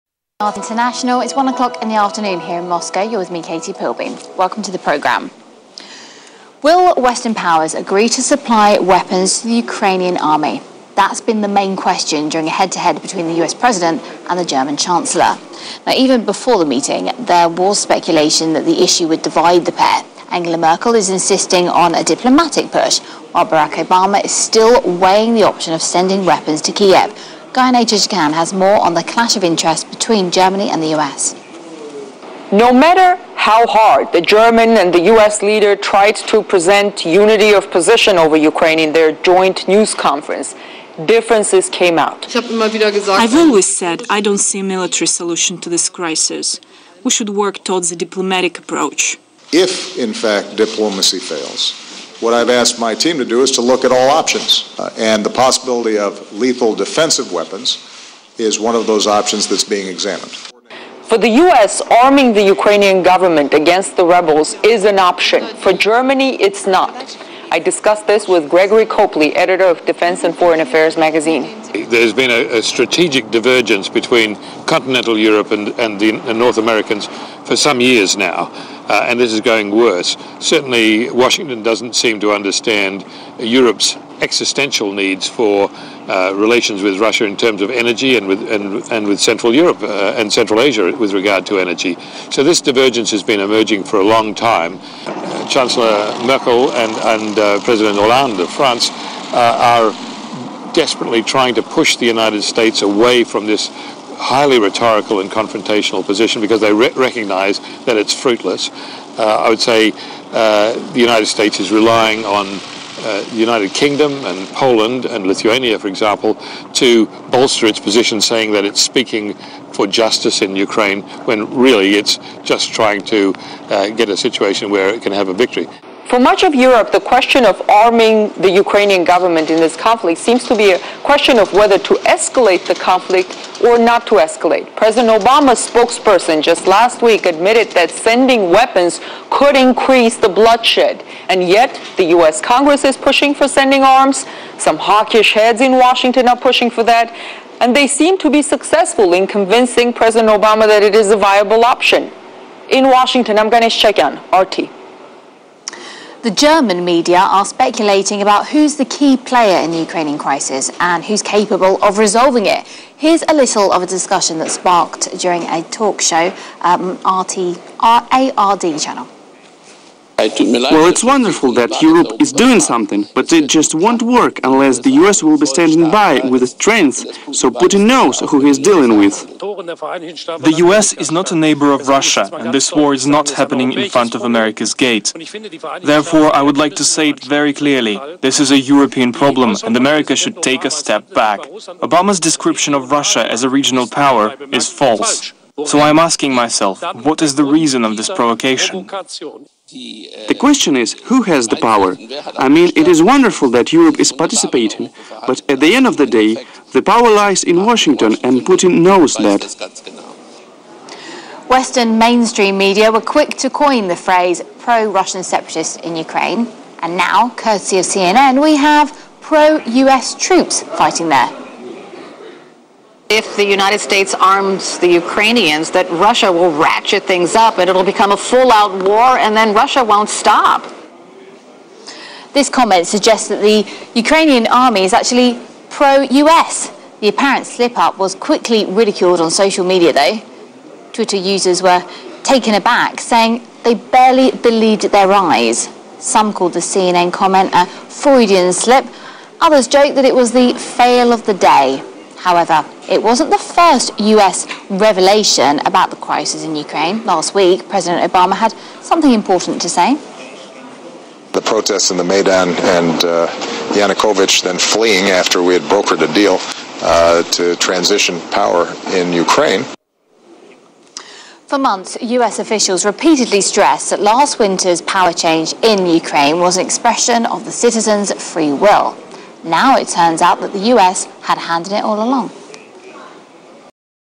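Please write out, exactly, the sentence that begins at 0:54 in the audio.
Uh, and the possibility of lethal defensive weapons is one of those options that's being examined.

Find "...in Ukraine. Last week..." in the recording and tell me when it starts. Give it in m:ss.
4:16.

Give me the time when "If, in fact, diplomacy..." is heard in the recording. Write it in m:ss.
0:49.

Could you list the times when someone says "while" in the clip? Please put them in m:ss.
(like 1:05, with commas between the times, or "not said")
0:23.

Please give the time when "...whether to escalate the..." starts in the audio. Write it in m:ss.
2:11.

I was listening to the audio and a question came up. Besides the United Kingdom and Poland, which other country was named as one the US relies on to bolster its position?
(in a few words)
Lithuania.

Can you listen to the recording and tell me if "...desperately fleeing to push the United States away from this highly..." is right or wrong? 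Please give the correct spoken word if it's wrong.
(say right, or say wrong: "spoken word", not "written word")
wrong: "trying", not "fleeing".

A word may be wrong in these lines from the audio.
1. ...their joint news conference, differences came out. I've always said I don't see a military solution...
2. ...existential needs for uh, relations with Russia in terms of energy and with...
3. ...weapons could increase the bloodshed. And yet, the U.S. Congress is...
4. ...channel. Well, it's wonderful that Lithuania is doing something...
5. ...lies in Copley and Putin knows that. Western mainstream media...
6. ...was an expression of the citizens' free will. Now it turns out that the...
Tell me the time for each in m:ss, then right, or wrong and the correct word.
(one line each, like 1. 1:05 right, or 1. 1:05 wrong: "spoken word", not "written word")
1. 0:38 right
2. 1:24 right
3. 2:18 right
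4. 2:48 wrong: "Europe", not "Lithuania"
5. 3:27 wrong: "Washington", not "Copley"
6. 4:36 right.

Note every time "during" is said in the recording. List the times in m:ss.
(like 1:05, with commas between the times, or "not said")
0:12, 2:45.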